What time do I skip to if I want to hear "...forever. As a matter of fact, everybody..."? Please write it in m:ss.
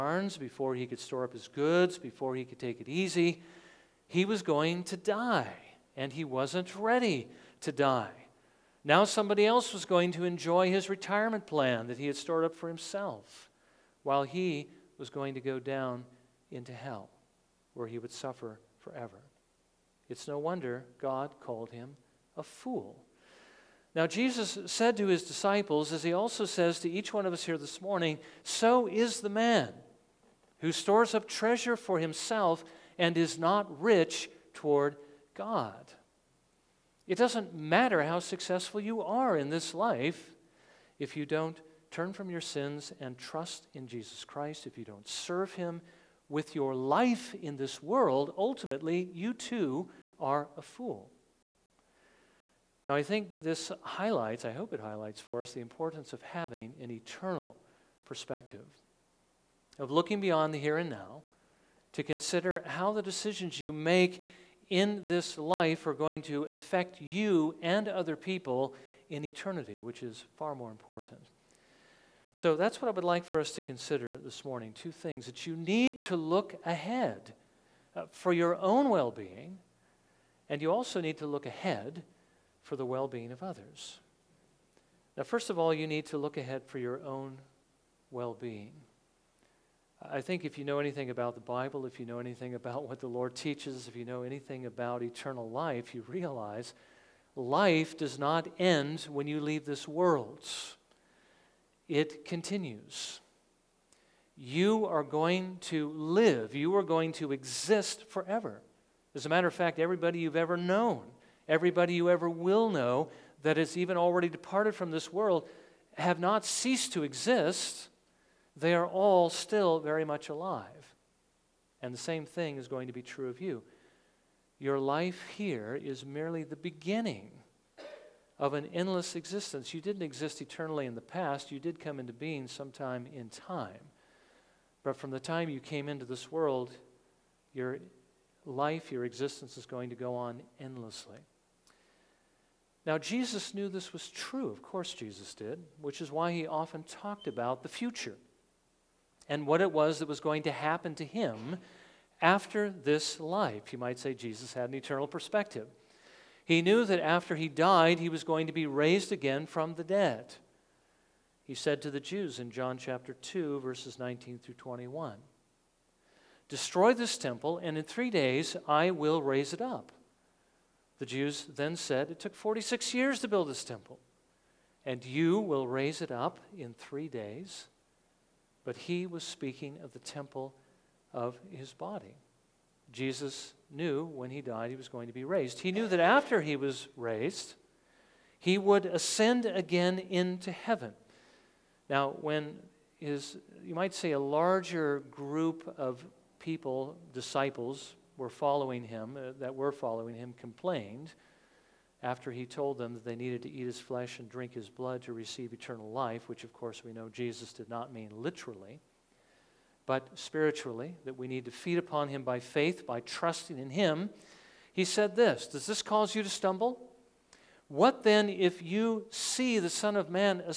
1:48.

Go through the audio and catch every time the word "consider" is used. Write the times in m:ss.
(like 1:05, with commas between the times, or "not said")
1:02, 1:13.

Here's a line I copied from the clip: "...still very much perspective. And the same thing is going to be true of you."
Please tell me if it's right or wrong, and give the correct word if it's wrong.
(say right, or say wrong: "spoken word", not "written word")
wrong: "alive", not "perspective".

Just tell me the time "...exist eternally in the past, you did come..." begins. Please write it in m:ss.
2:10.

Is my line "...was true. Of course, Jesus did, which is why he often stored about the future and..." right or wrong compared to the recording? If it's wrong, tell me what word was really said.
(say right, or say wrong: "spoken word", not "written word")
wrong: "talked", not "stored".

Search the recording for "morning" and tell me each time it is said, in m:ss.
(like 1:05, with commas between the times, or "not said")
0:27, 1:14.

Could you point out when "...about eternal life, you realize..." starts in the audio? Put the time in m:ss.
1:34.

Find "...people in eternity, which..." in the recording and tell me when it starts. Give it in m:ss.
1:08.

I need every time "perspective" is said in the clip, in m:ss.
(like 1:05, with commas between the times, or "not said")
0:58, 2:35.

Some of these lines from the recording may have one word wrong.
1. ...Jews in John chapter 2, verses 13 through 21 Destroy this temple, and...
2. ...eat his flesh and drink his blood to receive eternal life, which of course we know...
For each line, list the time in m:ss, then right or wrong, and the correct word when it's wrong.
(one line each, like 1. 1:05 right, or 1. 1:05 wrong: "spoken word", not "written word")
1. 2:41 wrong: "19", not "13"
2. 3:23 right.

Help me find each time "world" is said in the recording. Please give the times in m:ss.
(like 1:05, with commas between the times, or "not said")
0:47, 1:39, 1:55, 2:16.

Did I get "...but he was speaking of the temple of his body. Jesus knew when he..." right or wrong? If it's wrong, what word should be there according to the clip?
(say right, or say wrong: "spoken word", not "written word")
right.